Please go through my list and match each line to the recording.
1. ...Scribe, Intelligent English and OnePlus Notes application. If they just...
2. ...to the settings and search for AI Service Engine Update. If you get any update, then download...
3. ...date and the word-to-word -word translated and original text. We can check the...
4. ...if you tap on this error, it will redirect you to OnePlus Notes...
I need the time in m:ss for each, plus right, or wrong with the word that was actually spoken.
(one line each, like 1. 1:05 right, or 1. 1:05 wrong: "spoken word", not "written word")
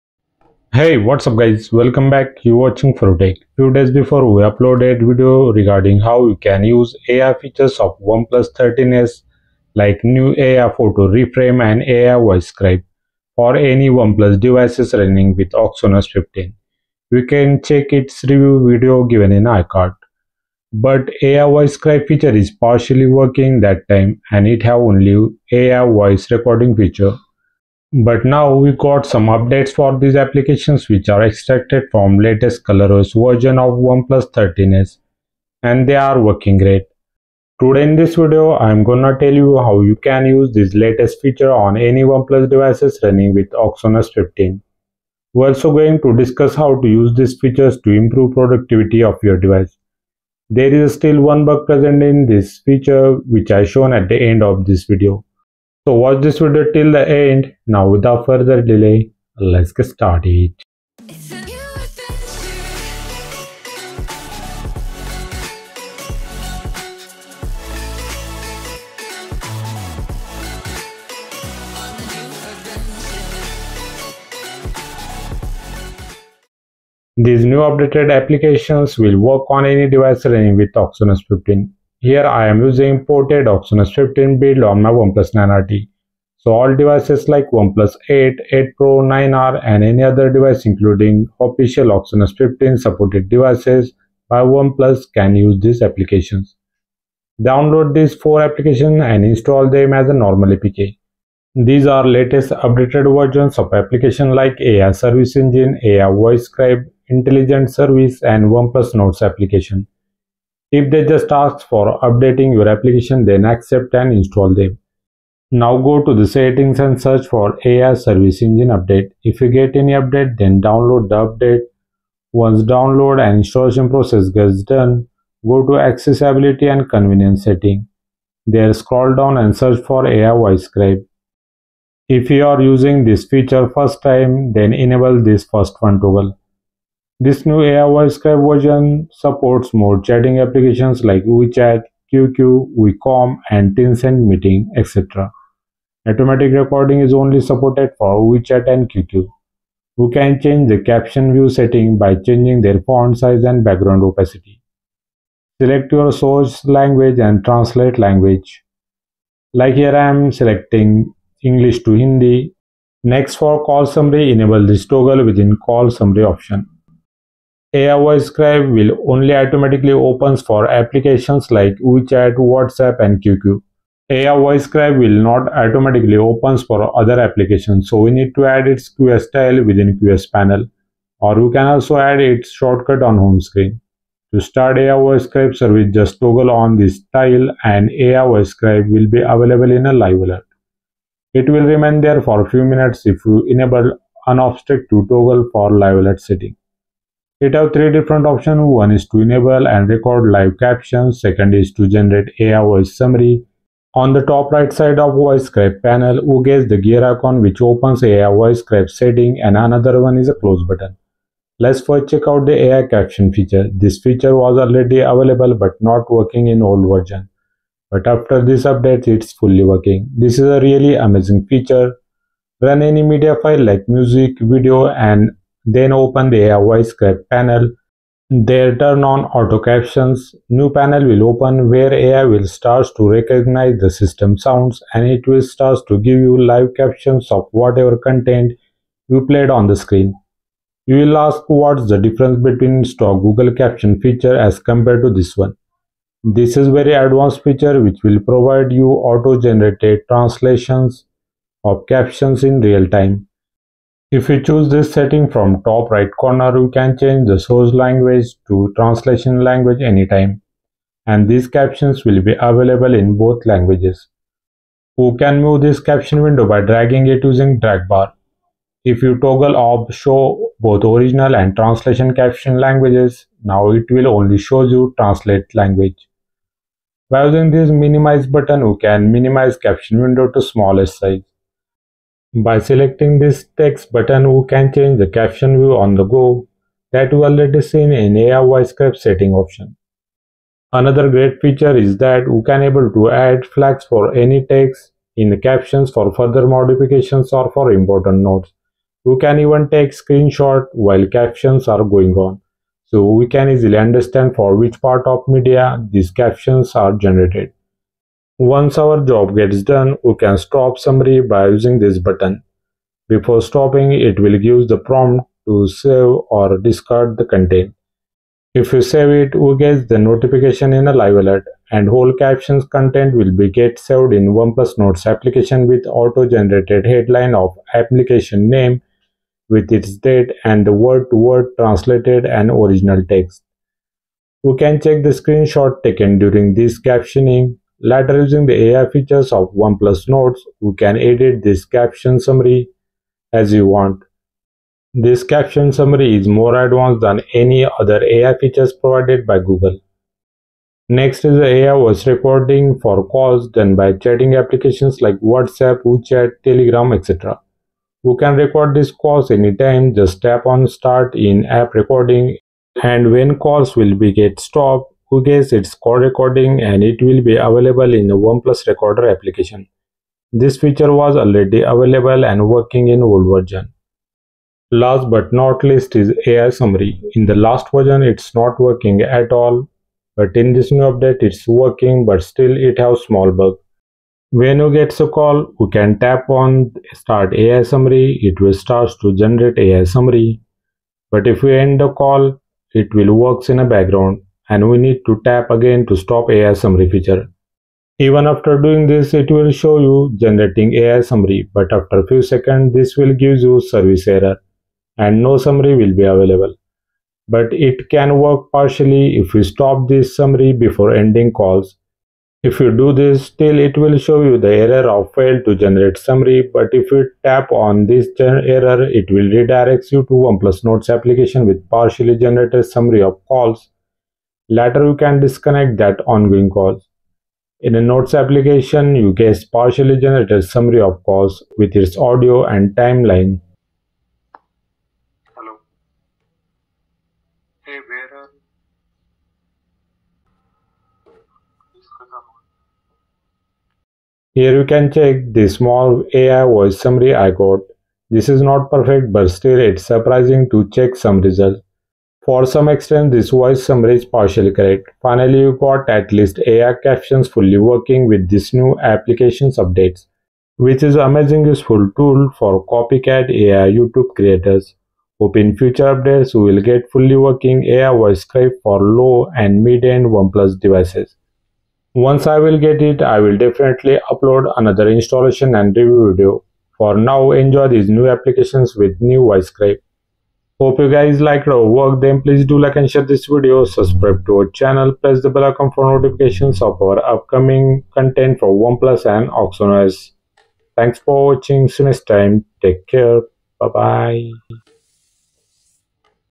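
1. 1:46 wrong: "Service", not "English"
2. 1:56 right
3. 5:30 right
4. 6:56 right.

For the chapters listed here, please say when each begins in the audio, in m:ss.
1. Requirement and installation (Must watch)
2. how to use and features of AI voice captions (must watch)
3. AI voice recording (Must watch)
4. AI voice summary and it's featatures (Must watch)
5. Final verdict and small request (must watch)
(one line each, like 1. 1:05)
1. 1:16
2. 3:31
3. 5:50
4. 6:14
5. 7:35.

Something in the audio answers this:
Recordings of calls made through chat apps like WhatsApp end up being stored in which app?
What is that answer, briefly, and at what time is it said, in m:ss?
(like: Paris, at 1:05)
OnePlus Recorder, at 6:08.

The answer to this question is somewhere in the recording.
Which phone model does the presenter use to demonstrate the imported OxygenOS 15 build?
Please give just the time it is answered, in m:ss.
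1:24.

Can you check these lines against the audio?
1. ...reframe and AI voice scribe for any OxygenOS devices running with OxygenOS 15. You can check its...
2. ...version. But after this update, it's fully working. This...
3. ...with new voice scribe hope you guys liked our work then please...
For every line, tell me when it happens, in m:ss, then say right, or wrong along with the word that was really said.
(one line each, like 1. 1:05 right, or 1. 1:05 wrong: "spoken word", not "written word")
1. 0:11 wrong: "OnePlus", not "OxygenOS"
2. 3:36 right
3. 7:58 right.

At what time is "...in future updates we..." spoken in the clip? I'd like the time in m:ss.
7:45.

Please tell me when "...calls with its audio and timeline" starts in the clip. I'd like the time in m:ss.
7:11.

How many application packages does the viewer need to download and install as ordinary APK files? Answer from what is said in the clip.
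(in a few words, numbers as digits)
4.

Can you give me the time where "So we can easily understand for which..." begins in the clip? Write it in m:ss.
5:02.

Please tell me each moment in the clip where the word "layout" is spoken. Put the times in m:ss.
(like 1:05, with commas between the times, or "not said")
not said.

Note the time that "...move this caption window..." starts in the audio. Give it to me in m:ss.
4:25.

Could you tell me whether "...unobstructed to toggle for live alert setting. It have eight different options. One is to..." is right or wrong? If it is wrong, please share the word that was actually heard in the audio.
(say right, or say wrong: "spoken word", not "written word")
wrong: "three", not "eight".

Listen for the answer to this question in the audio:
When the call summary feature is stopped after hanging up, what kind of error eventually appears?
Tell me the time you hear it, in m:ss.
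6:43.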